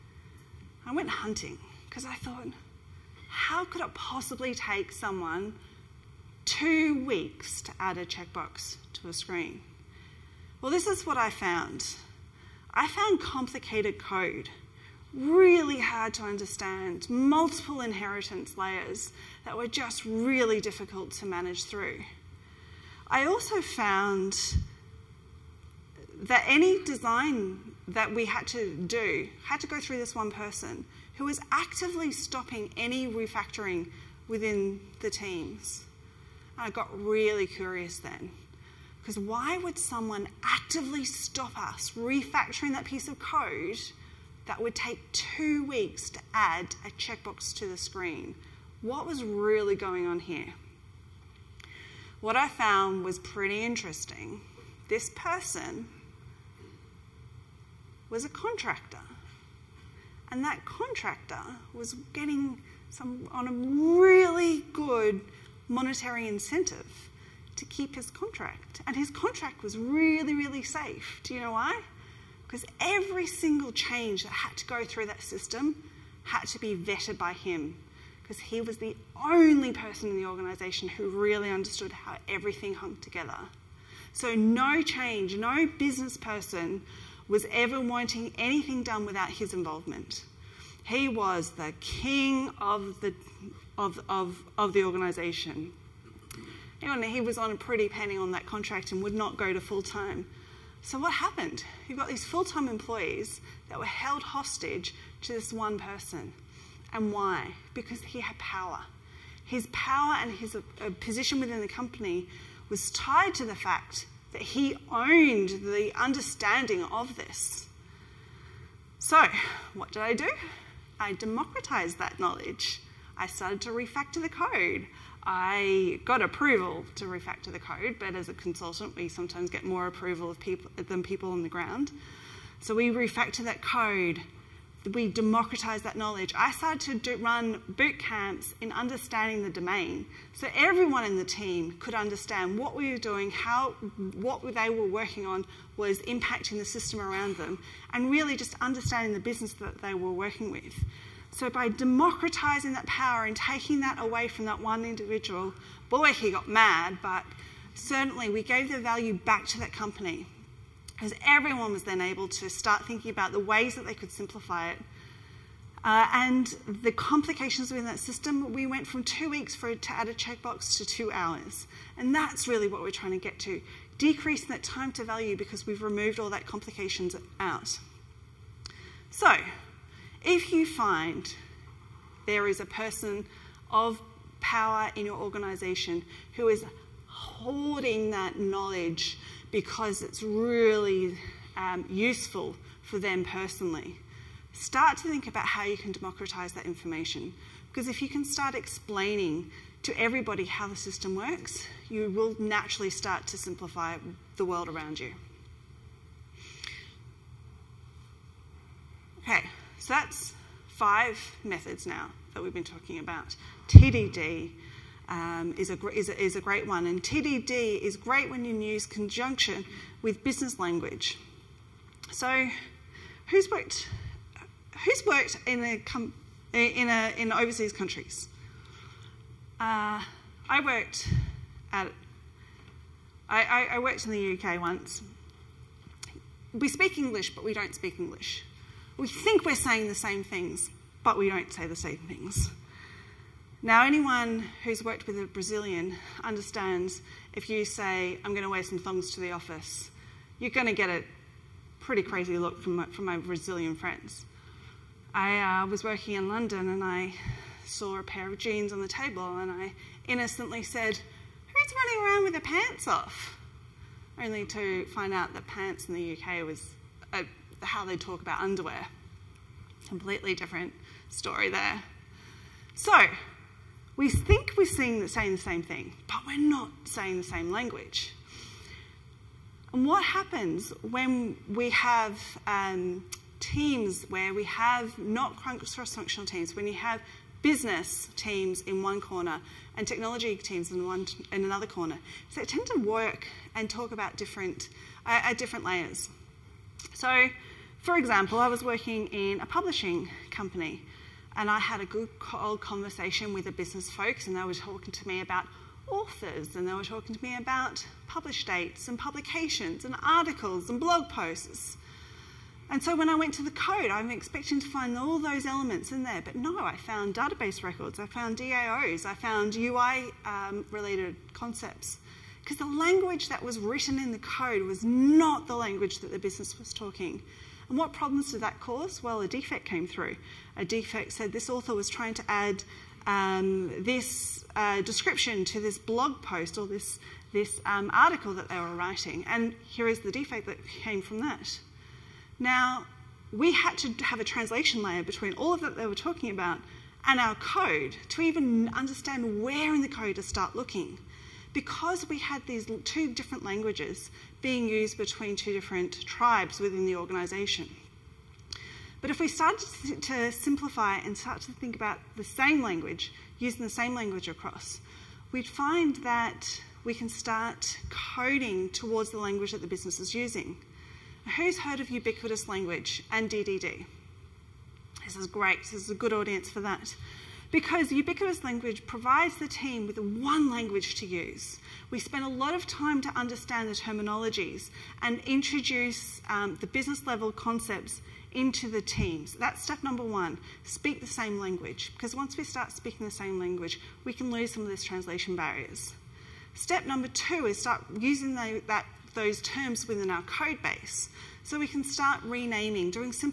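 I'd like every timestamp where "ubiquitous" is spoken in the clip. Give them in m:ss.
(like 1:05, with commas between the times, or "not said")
6:11, 6:17.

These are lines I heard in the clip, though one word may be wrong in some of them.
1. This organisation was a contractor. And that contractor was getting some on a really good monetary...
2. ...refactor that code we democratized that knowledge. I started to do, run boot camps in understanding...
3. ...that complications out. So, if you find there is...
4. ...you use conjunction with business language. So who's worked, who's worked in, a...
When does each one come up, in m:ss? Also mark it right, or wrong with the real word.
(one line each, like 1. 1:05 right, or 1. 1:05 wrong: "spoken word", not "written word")
1. 0:54 wrong: "person", not "organisation"
2. 2:12 right
3. 2:56 right
4. 3:38 right.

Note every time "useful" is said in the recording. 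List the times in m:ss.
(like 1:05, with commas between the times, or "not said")
3:11.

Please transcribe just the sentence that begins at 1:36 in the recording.
Anyway, he was on a pretty penny on that contract and would not go to full time.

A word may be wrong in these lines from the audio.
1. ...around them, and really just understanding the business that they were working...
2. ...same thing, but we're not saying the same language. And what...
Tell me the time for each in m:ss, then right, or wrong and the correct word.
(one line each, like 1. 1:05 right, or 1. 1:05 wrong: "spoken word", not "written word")
1. 2:27 right
2. 4:35 right.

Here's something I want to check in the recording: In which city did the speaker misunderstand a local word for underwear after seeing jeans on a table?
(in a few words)
London.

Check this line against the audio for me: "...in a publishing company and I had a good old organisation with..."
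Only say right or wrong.
wrong.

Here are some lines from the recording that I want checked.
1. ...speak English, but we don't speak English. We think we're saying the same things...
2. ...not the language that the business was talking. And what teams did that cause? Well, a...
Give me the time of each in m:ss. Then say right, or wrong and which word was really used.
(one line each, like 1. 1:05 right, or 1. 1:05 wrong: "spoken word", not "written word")
1. 3:56 right
2. 5:24 wrong: "problems", not "teams".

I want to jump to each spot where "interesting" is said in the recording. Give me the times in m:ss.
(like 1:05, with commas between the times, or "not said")
0:53.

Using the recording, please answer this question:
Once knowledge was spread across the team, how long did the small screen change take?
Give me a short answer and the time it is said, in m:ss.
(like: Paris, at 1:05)
two hours, at 2:50.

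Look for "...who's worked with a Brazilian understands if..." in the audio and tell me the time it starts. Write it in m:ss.
4:04.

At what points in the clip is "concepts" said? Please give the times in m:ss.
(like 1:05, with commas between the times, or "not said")
5:21, 6:27.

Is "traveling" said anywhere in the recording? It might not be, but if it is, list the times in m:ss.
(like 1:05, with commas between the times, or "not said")
not said.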